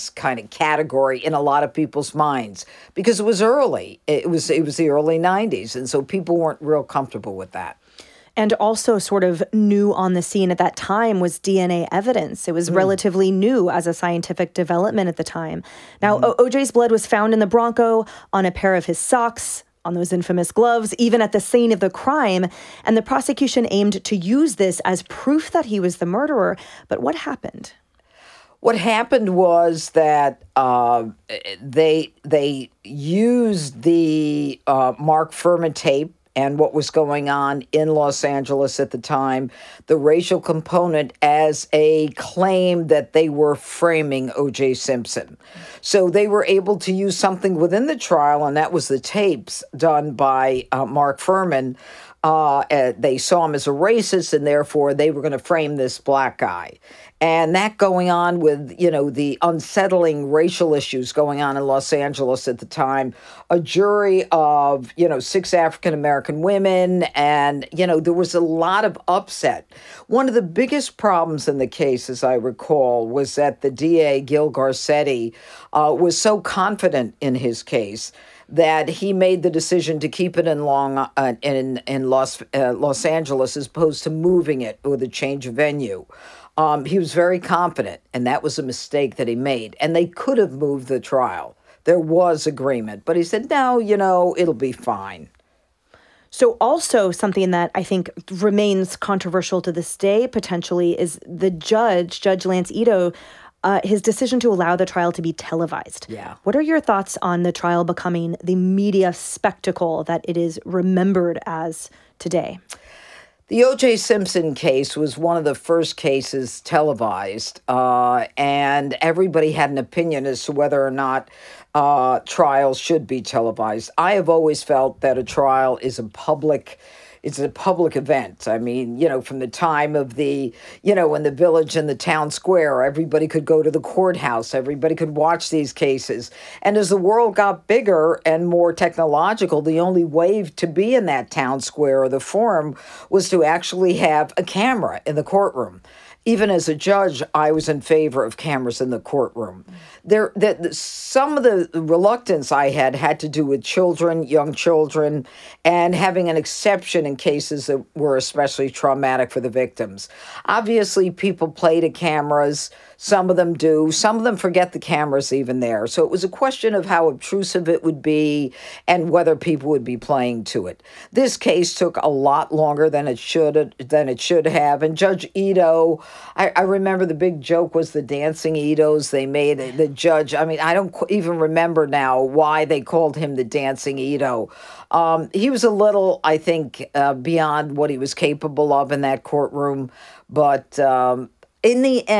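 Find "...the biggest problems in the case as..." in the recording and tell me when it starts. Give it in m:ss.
1:10.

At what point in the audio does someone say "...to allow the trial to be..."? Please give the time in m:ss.
1:44.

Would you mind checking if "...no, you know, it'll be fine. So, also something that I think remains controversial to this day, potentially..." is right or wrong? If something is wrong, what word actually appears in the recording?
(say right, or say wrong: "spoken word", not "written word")
right.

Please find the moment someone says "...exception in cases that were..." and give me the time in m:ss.
2:36.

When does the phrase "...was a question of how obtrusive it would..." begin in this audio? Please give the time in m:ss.
2:46.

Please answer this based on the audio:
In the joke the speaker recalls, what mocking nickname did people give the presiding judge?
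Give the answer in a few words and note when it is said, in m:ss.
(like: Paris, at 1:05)
The dancing Itos, at 2:57.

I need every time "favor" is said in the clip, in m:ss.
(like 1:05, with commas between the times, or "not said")
2:27.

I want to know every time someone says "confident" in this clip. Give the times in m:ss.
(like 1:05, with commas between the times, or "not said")
1:16, 1:27.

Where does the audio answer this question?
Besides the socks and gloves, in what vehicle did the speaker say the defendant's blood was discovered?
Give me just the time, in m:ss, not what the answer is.
0:17.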